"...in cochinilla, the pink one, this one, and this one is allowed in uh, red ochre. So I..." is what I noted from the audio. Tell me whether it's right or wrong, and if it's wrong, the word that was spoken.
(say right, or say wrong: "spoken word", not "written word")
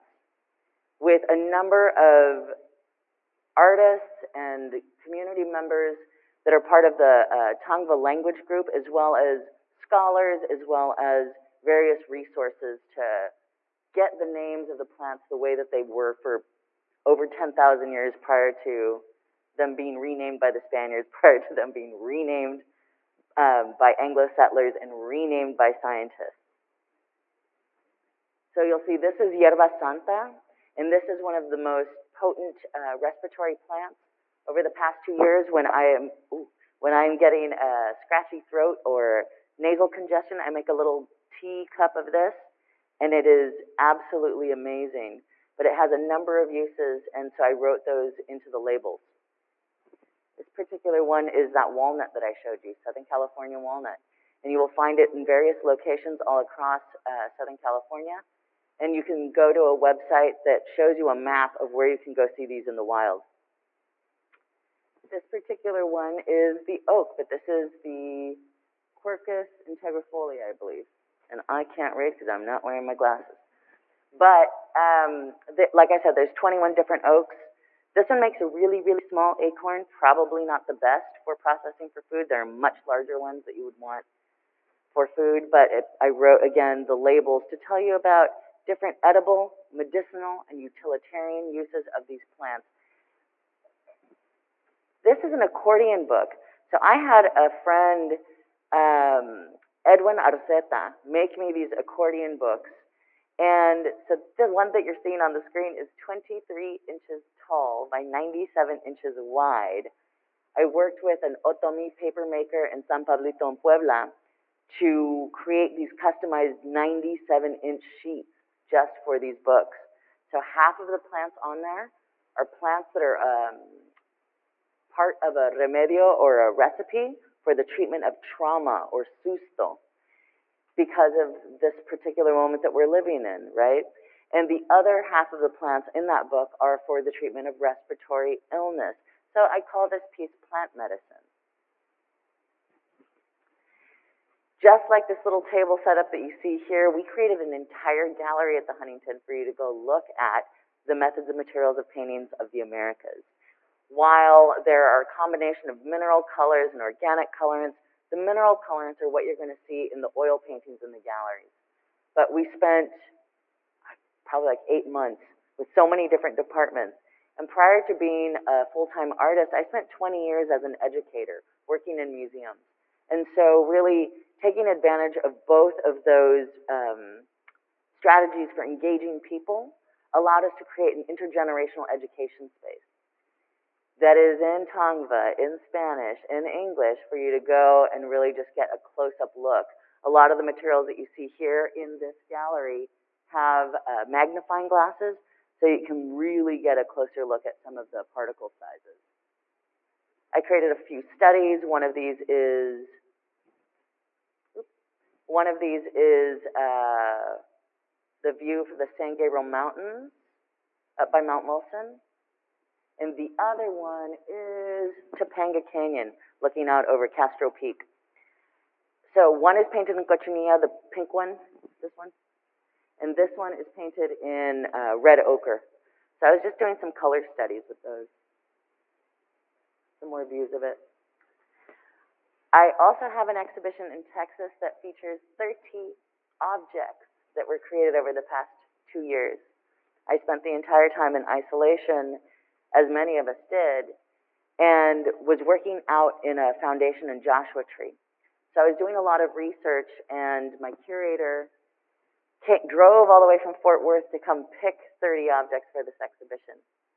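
wrong: "painted", not "allowed".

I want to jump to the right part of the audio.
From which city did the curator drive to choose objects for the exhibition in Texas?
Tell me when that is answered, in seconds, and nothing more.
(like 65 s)
253 s.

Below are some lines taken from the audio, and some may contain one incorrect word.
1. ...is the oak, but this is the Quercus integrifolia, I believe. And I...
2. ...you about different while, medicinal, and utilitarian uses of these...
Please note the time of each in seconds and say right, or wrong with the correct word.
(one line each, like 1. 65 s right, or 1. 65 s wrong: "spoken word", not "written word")
1. 66 s right
2. 87 s wrong: "edible", not "while".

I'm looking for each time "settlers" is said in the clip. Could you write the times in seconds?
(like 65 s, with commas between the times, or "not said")
24 s.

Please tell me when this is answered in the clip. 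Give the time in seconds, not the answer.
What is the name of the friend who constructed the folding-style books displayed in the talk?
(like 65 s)
99 s.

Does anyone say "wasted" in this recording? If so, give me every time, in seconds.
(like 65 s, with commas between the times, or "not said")
not said.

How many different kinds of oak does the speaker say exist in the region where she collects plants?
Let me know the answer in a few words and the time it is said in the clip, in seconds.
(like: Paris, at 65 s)
21, at 76 s.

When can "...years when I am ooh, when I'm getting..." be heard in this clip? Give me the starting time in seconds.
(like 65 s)
35 s.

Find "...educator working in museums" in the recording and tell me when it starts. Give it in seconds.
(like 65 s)
170 s.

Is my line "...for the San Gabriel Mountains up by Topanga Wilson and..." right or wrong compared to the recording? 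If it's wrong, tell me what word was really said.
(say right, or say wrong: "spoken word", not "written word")
wrong: "Mount", not "Topanga".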